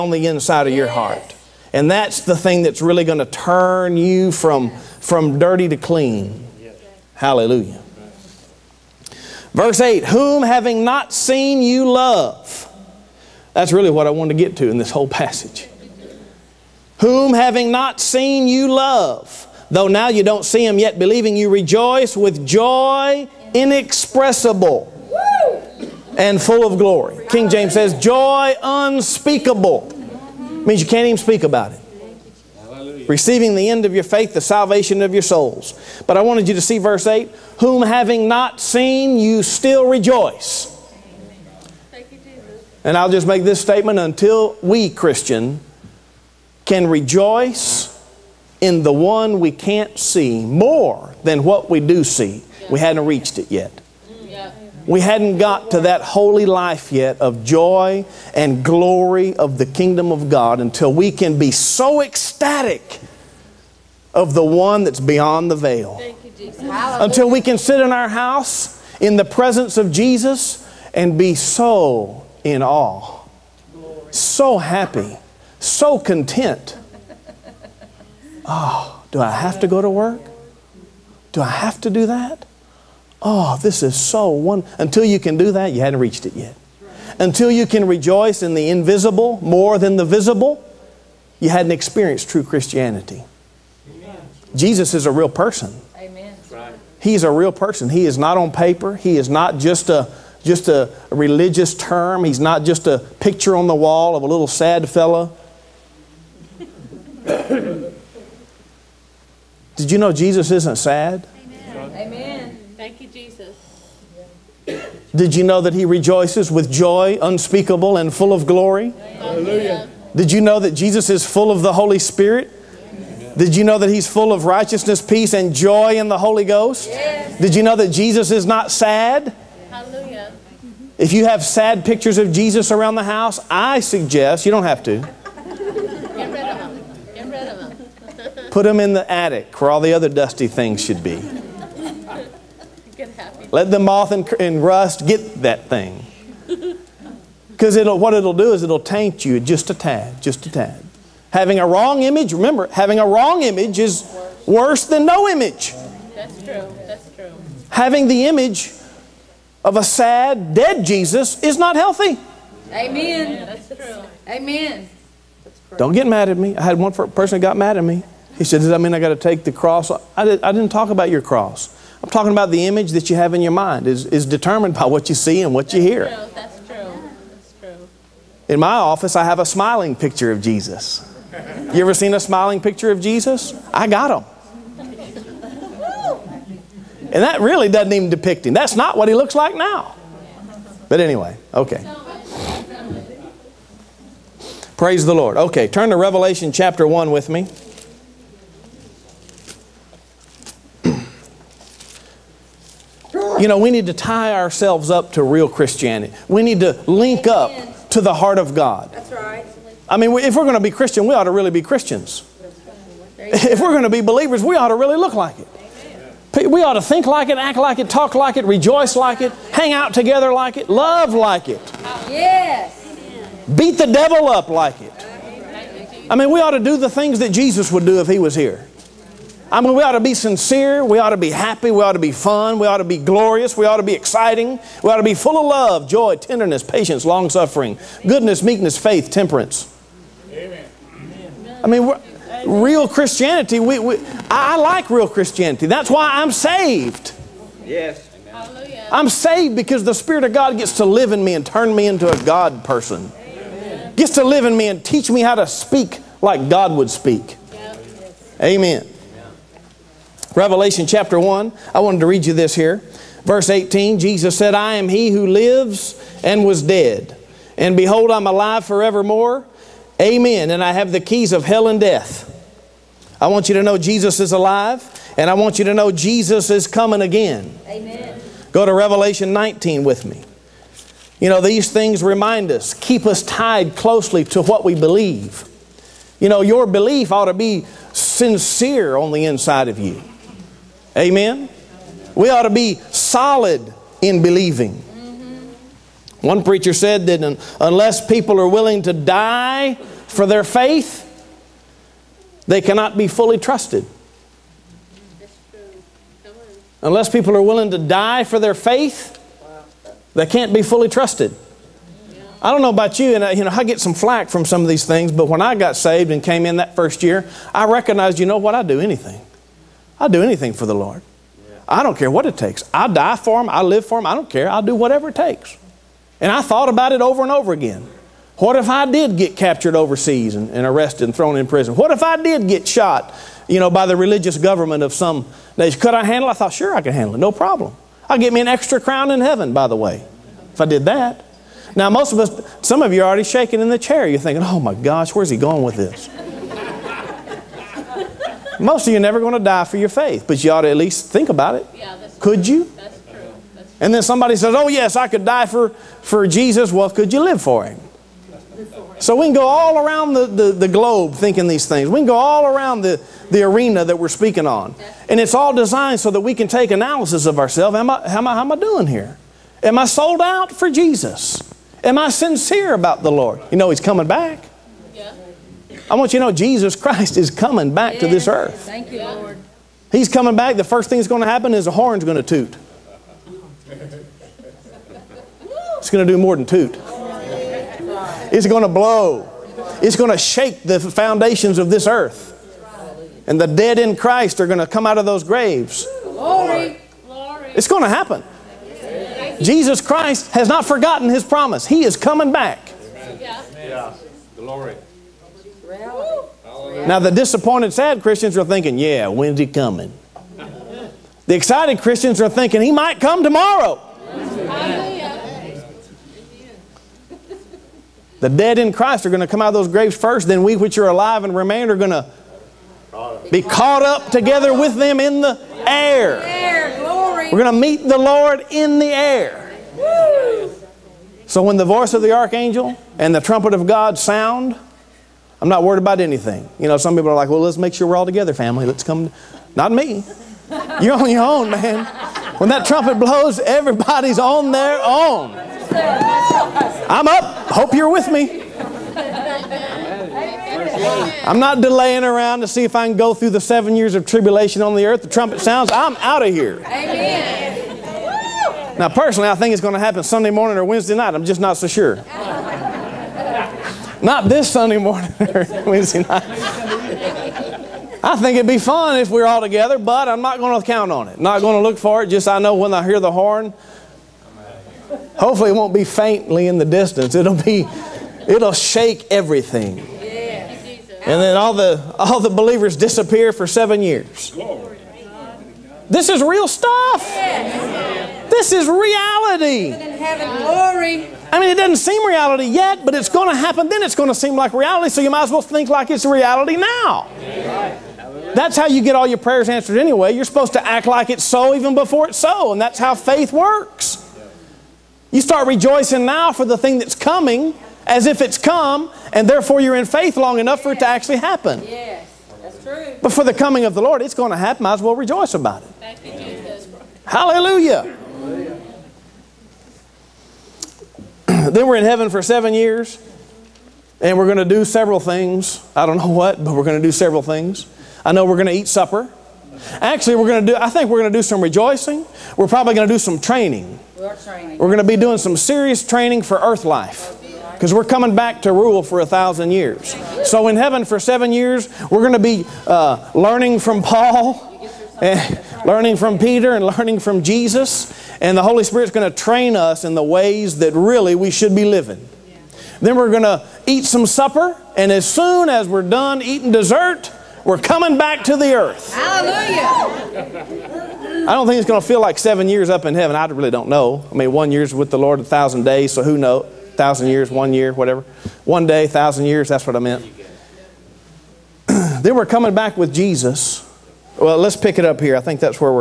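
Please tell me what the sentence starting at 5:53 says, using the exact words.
And then somebody says, oh, yes, I could die for, for Jesus.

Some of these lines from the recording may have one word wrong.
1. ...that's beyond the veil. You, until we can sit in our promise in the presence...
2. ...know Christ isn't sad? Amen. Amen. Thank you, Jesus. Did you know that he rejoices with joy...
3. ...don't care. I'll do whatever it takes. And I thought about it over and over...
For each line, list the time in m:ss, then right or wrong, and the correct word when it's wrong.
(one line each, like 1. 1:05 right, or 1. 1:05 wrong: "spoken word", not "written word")
1. 1:04 wrong: "house", not "promise"
2. 1:49 wrong: "Jesus", not "Christ"
3. 5:24 right.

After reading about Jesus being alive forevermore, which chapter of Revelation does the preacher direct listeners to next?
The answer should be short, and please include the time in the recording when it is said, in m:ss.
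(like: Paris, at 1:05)
Revelation 19, at 4:38.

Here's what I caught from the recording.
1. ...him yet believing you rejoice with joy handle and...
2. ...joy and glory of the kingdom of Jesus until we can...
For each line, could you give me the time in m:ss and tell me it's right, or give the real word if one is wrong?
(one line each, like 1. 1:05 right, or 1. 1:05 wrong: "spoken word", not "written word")
1. 0:20 wrong: "inexpressible", not "handle"
2. 0:57 wrong: "God", not "Jesus".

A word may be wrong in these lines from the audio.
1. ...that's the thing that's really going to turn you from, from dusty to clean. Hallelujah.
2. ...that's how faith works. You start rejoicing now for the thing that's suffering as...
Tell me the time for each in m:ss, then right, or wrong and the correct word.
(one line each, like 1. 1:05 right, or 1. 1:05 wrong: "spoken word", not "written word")
1. 0:01 wrong: "dirty", not "dusty"
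2. 8:22 wrong: "coming", not "suffering".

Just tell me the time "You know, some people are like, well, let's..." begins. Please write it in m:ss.
7:16.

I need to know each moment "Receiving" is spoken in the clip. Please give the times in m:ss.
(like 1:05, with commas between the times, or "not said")
0:33.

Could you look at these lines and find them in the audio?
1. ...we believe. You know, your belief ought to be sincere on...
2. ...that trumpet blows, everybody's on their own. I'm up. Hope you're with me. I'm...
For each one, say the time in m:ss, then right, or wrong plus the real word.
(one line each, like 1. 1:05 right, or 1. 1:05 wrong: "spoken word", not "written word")
1. 4:44 right
2. 7:22 right.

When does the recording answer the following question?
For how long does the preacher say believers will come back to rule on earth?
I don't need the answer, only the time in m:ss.
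8:59.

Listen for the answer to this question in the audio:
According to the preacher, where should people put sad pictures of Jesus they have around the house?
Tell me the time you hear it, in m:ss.
2:18.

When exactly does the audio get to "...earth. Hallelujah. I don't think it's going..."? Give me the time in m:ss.
9:18.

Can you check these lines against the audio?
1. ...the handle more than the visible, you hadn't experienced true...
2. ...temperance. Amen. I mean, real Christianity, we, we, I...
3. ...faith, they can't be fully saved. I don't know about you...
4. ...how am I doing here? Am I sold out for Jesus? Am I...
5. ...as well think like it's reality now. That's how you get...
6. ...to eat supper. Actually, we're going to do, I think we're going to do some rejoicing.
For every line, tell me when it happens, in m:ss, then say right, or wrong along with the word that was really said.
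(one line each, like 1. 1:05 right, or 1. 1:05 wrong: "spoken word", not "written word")
1. 1:28 wrong: "invisible", not "handle"
2. 3:59 right
3. 5:08 wrong: "trusted", not "saved"
4. 6:08 right
5. 8:15 right
6. 8:48 right.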